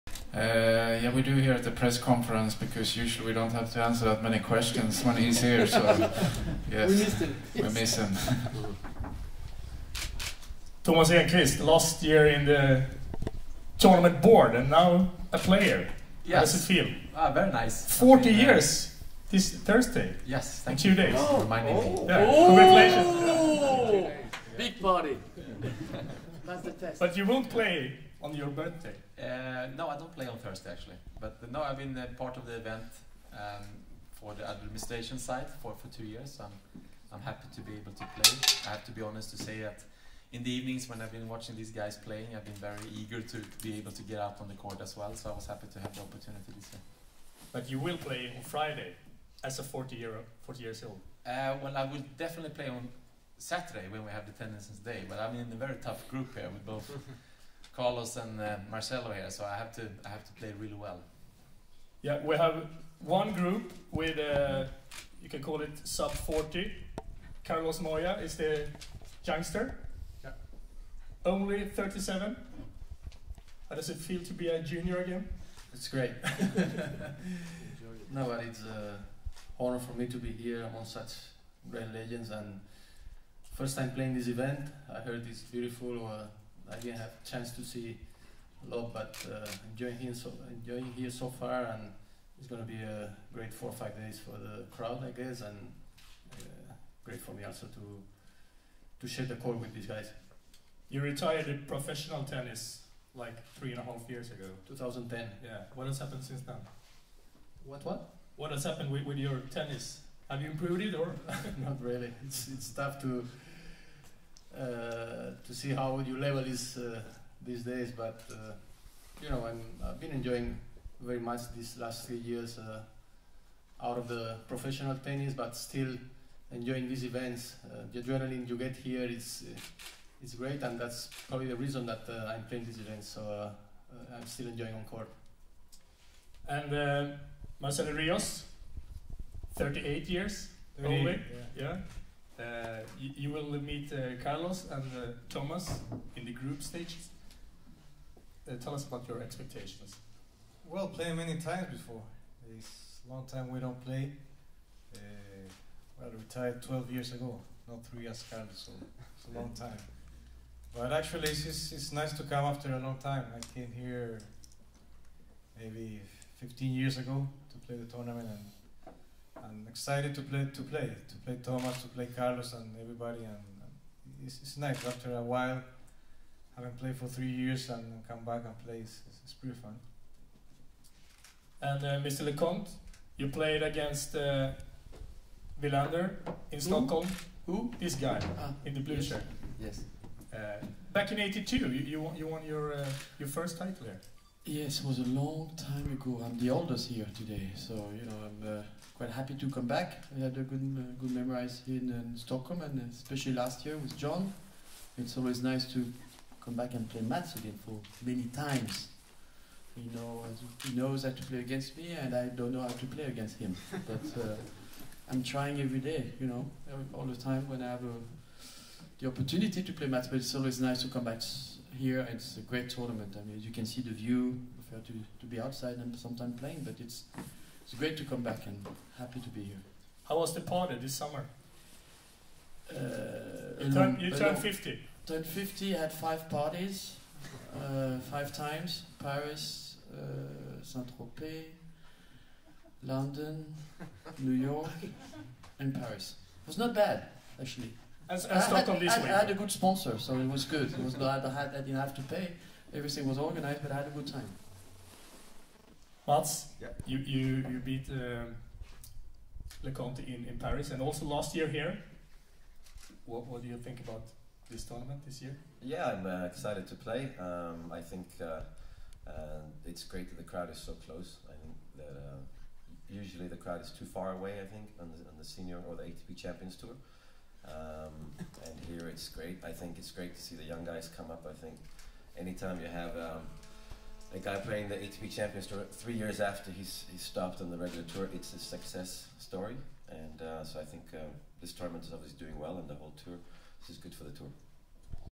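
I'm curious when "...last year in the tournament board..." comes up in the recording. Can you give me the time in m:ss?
0:11.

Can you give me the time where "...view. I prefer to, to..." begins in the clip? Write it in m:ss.
3:43.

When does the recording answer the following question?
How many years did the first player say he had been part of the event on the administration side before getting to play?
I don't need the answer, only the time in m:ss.
0:35.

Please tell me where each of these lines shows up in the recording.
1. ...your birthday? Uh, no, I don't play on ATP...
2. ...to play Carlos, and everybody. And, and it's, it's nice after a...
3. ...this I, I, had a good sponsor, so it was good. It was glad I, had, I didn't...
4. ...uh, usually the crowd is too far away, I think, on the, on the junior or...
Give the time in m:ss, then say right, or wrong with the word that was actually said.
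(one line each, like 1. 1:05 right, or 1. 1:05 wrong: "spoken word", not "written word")
1. 0:28 wrong: "Thursday", not "ATP"
2. 2:51 right
3. 4:08 right
4. 4:31 wrong: "senior", not "junior".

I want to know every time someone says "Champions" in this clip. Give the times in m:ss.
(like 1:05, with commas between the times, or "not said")
4:36, 4:45.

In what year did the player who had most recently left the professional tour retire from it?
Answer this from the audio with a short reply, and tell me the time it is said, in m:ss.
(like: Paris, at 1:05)
2010, at 1:44.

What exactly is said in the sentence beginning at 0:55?
But I'm in a very tough group here with both.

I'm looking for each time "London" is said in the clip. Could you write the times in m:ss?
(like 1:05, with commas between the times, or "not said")
4:02.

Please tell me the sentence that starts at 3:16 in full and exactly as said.
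I'm the oldest here today, so you know I'm uh, quite happy to come back.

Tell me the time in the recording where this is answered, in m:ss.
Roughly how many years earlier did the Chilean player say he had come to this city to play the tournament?
2:46.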